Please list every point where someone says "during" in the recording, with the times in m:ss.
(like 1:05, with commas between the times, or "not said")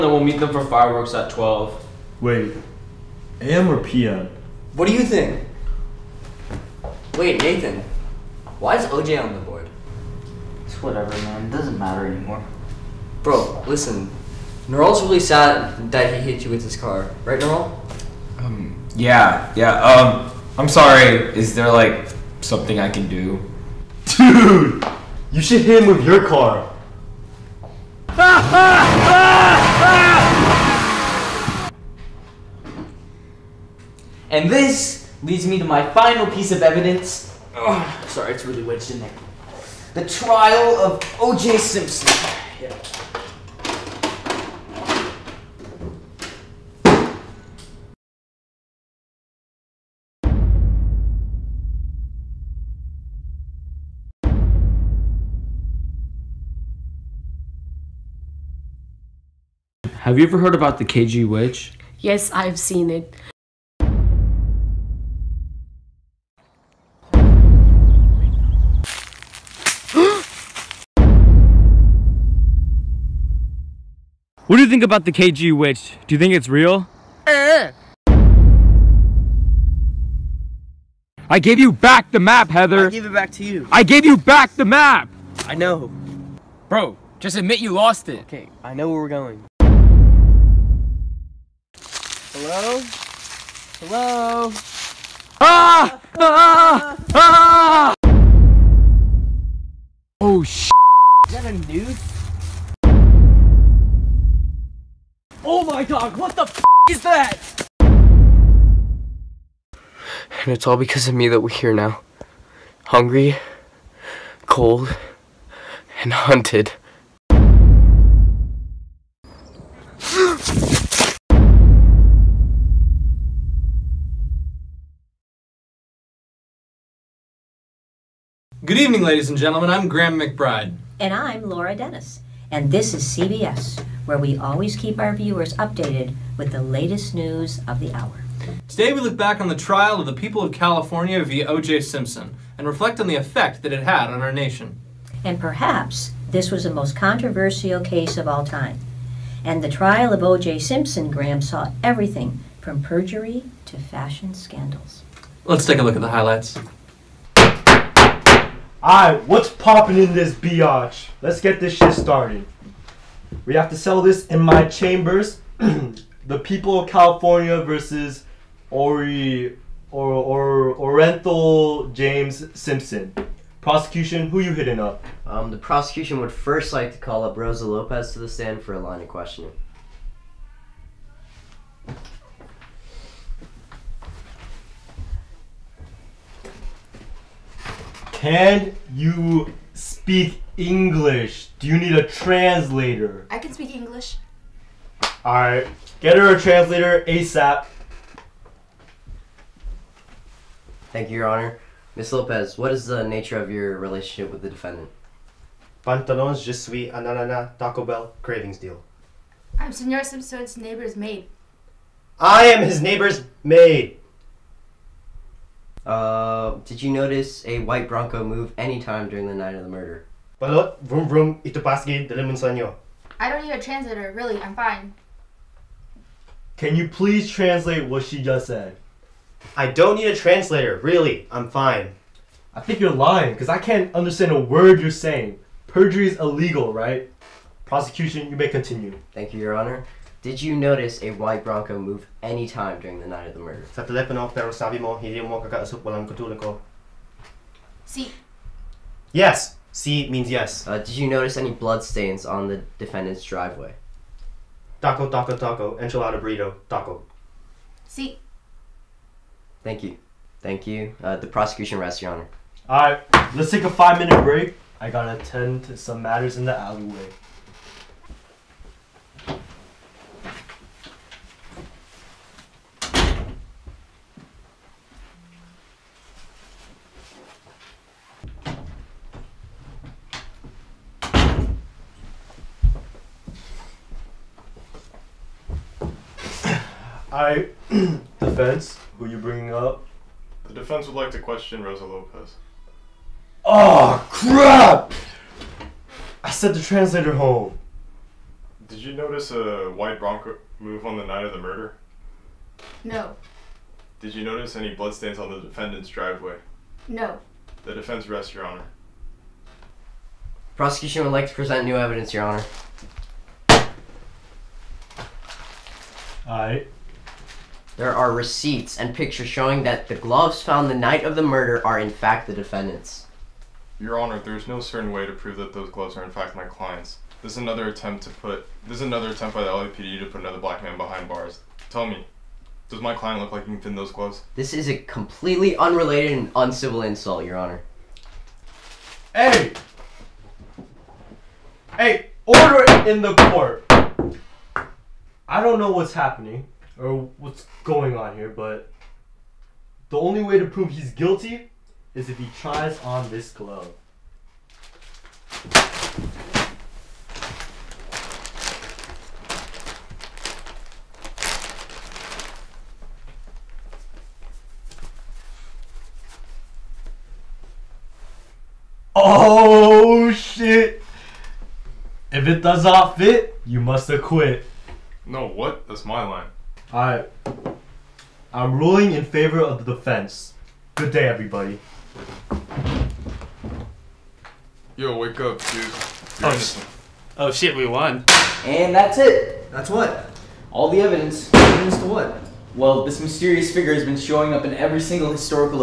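3:39, 4:02.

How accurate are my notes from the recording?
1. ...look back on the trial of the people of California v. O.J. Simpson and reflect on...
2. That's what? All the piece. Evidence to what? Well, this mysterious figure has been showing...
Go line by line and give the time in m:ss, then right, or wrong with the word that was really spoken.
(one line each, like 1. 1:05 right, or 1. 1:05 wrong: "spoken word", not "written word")
1. 2:19 right
2. 6:29 wrong: "evidence", not "piece".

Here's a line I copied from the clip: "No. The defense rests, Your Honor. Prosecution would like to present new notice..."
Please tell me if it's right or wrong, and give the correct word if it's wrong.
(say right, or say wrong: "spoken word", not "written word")
wrong: "evidence", not "notice".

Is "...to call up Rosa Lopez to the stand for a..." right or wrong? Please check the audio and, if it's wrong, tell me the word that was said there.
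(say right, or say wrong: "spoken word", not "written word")
right.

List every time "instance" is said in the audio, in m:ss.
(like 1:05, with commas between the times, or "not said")
not said.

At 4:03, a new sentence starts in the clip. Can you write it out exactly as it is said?
Sa telepono, pero sabi mo, hindi mo kakausap walang katulad ko.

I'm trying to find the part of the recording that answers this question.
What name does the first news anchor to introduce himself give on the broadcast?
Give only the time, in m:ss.
2:09.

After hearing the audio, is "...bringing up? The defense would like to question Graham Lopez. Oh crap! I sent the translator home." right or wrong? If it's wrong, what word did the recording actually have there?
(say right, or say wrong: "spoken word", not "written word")
wrong: "Rosa", not "Graham".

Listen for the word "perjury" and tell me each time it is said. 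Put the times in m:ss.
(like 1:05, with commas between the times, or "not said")
2:32, 3:55.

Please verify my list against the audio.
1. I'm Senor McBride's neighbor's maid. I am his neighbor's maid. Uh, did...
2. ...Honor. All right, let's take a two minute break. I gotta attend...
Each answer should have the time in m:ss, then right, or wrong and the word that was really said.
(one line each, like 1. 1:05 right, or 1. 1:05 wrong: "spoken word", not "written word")
1. 3:29 wrong: "Simpson", not "McBride"
2. 4:22 wrong: "five", not "two".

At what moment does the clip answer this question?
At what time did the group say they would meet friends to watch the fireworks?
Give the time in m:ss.
0:01.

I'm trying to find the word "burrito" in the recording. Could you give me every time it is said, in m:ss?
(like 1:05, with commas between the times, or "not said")
4:16.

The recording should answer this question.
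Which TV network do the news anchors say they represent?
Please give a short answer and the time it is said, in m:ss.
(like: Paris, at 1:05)
CBS, at 2:13.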